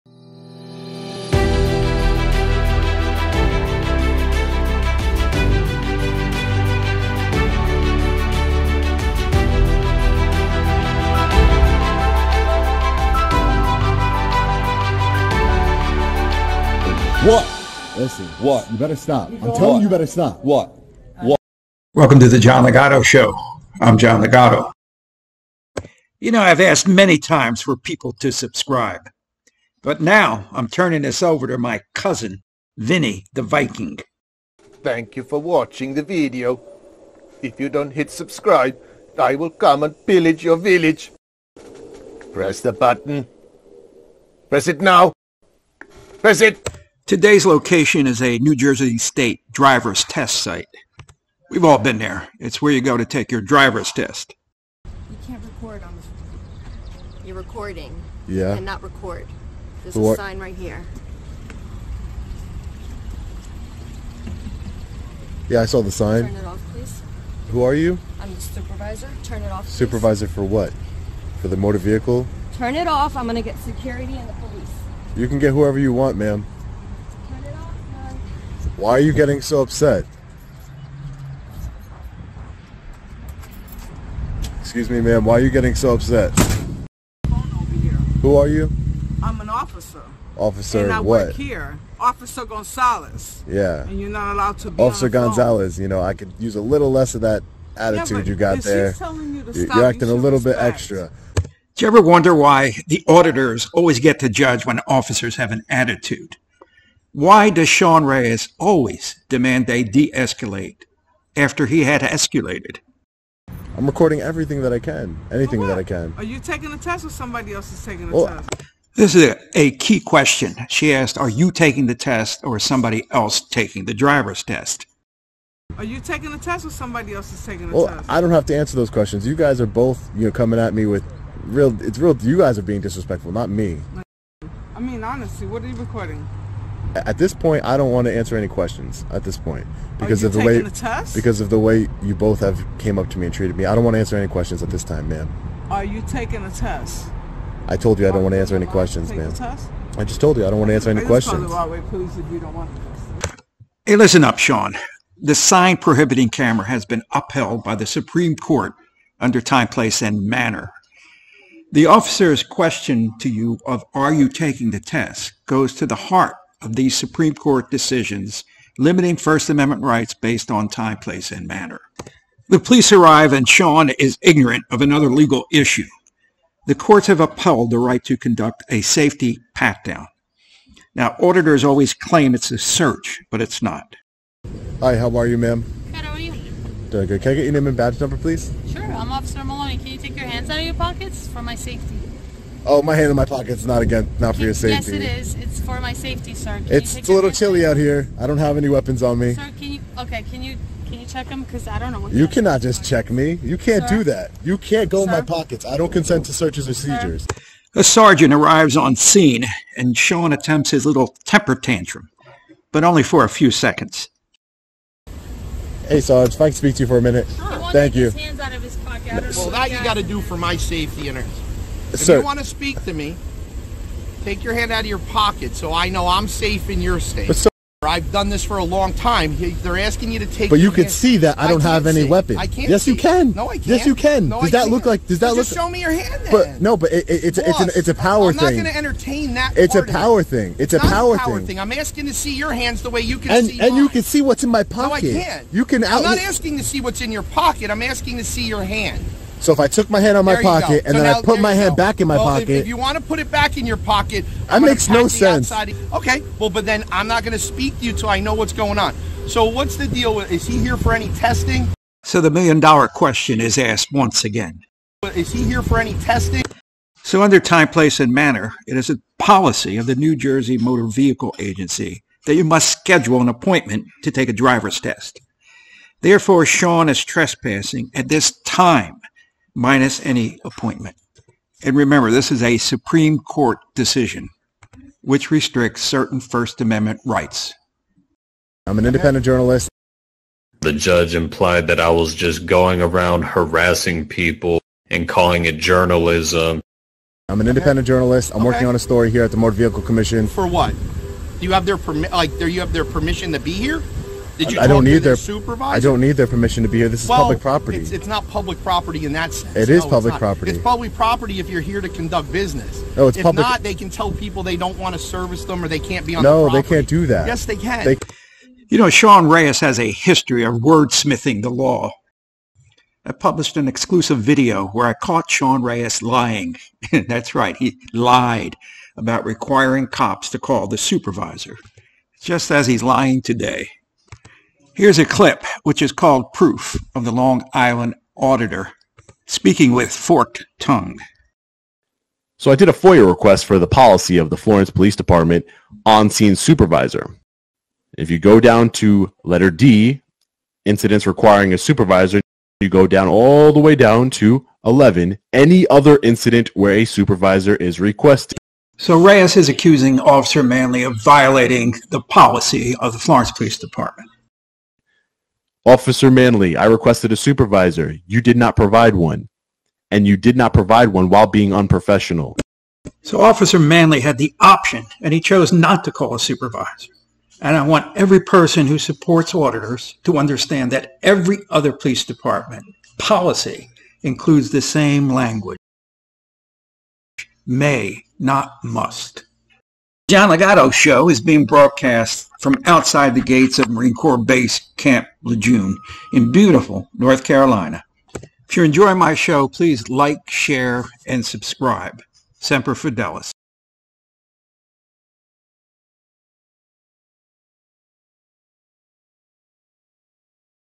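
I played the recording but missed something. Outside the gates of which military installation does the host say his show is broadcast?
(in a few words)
Camp Lejeune.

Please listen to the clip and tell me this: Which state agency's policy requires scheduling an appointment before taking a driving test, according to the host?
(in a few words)
New Jersey Motor Vehicle Agency.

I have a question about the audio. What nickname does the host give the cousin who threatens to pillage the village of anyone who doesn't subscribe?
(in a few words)
Vinny the Viking.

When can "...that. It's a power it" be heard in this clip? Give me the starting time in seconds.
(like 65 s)
239 s.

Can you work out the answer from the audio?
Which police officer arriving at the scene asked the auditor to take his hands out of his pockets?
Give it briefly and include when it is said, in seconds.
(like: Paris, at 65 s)
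Officer Maloney, at 189 s.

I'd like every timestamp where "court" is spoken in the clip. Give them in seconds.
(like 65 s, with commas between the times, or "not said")
158 s, 167 s, 176 s, 283 s.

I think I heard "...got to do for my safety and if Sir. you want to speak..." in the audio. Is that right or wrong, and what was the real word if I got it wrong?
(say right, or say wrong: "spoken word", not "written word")
right.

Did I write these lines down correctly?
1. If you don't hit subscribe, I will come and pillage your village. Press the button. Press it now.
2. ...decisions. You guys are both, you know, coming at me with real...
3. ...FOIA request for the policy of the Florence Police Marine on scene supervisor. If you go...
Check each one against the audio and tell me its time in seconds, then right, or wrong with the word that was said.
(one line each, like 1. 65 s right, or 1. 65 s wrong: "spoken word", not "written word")
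1. 37 s right
2. 128 s wrong: "questions", not "decisions"
3. 342 s wrong: "Department", not "Marine".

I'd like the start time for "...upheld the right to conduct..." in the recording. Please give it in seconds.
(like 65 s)
177 s.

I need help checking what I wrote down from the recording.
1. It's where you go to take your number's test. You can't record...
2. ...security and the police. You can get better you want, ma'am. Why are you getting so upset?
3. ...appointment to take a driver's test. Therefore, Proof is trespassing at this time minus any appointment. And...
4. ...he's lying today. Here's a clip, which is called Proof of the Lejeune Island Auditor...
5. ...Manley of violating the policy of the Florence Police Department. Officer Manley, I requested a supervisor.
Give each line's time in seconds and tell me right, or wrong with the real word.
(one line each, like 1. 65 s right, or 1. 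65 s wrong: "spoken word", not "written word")
1. 52 s wrong: "driver", not "number"
2. 73 s wrong: "whoever", not "better"
3. 273 s wrong: "Sean", not "Proof"
4. 332 s wrong: "Long", not "Lejeune"
5. 360 s right.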